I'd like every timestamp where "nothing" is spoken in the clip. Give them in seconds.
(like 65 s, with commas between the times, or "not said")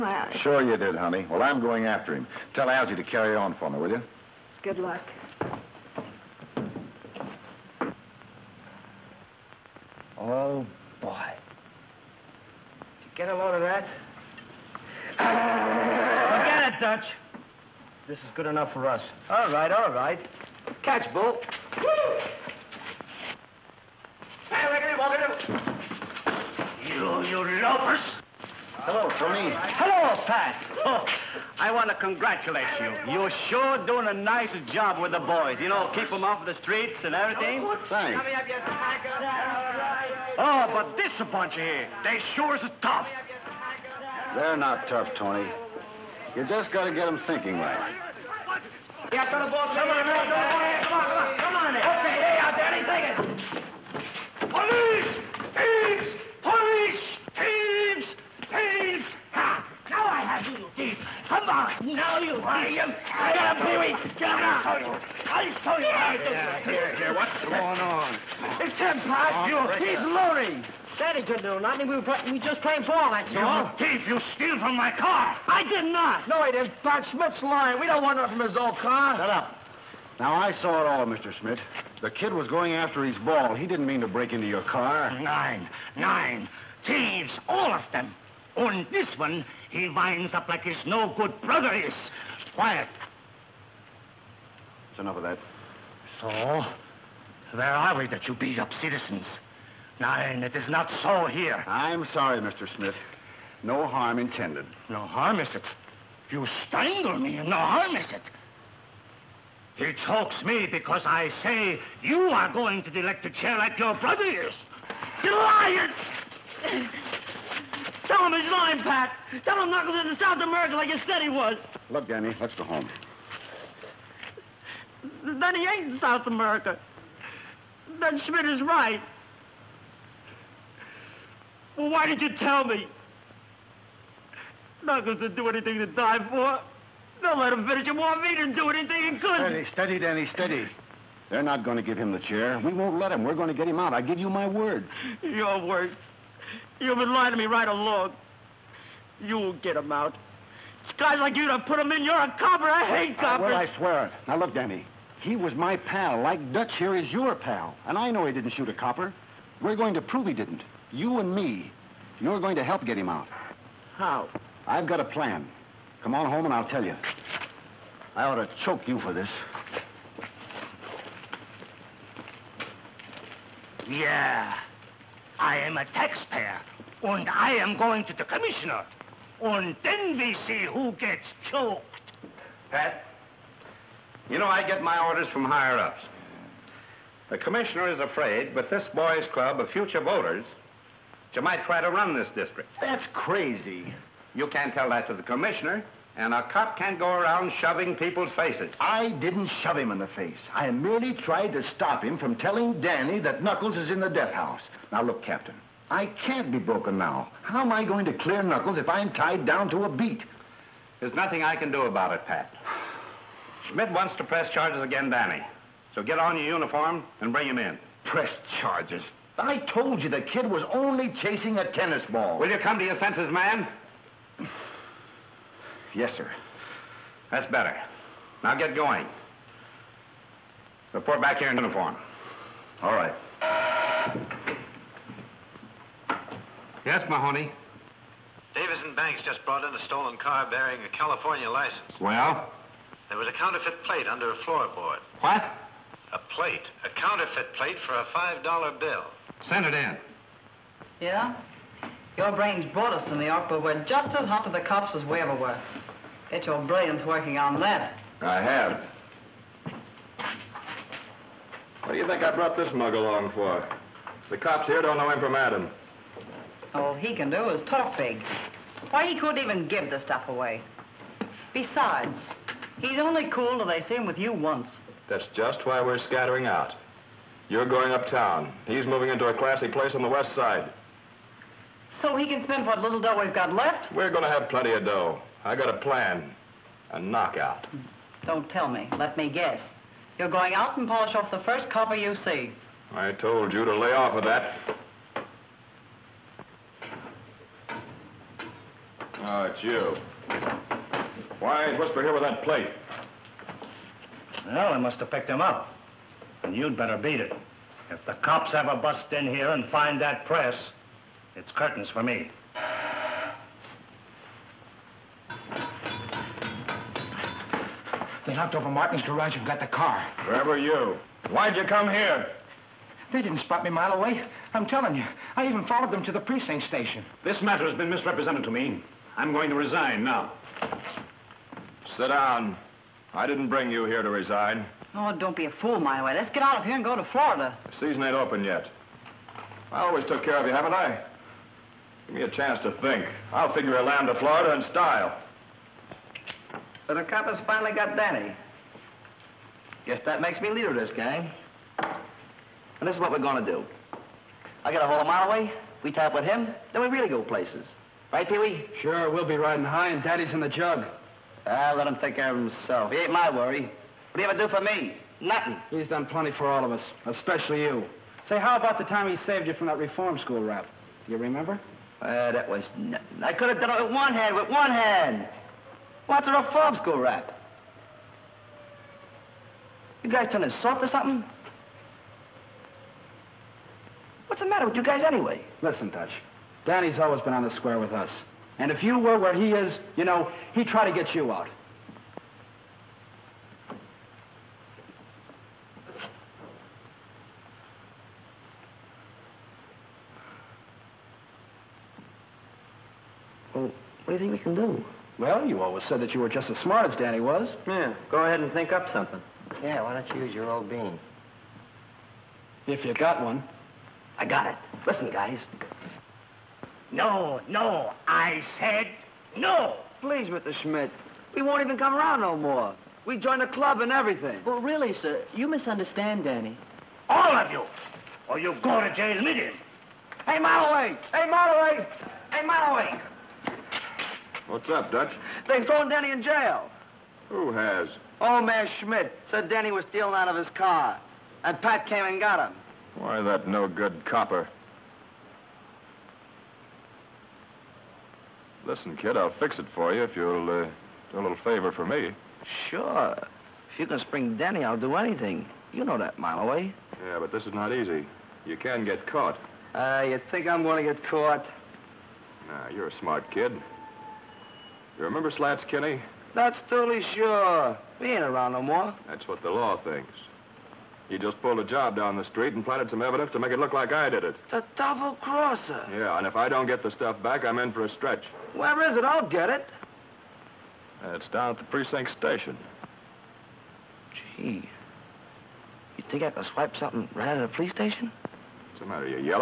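71 s, 78 s, 211 s, 365 s, 372 s.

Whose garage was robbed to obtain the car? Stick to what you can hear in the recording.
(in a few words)
Martin's.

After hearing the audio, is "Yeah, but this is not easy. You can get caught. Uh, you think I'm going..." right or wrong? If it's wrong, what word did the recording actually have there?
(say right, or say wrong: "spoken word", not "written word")
right.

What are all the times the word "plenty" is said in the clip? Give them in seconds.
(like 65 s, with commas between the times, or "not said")
284 s, 366 s.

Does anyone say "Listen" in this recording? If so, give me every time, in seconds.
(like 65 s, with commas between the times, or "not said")
385 s, 414 s, 448 s.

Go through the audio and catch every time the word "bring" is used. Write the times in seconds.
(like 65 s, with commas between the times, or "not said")
217 s, 333 s.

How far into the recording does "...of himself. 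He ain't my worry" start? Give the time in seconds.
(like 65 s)
362 s.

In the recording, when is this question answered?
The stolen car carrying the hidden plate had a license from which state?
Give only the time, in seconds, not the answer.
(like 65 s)
240 s.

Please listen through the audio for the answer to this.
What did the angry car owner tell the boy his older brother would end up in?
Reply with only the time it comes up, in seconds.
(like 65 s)
112 s.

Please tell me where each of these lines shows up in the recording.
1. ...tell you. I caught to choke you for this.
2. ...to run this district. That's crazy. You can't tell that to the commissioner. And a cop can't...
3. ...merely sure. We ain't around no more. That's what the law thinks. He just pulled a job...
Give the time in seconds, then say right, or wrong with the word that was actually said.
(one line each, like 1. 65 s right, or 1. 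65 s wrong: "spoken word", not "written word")
1. 166 s wrong: "ought", not "caught"
2. 191 s right
3. 466 s wrong: "totally", not "merely".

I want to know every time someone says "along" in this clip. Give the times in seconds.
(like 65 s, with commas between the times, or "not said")
147 s, 262 s.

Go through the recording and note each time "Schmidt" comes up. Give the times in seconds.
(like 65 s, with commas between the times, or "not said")
77 s, 81 s, 102 s, 128 s, 213 s, 420 s, 438 s.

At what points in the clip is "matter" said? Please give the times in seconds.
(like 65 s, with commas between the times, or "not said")
327 s, 384 s, 488 s.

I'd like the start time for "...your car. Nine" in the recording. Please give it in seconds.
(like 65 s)
84 s.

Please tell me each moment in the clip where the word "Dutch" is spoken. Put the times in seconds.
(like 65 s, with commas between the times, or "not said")
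16 s, 156 s, 385 s, 434 s.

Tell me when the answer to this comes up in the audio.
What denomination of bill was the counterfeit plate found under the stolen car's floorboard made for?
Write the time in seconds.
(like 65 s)
248 s.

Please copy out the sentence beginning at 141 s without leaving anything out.
They're not going to give him the chair.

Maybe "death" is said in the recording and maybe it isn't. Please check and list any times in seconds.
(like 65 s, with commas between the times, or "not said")
204 s.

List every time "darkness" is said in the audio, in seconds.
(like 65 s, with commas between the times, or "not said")
not said.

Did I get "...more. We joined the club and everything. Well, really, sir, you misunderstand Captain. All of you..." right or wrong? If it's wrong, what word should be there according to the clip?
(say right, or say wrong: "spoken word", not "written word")
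wrong: "Danny", not "Captain".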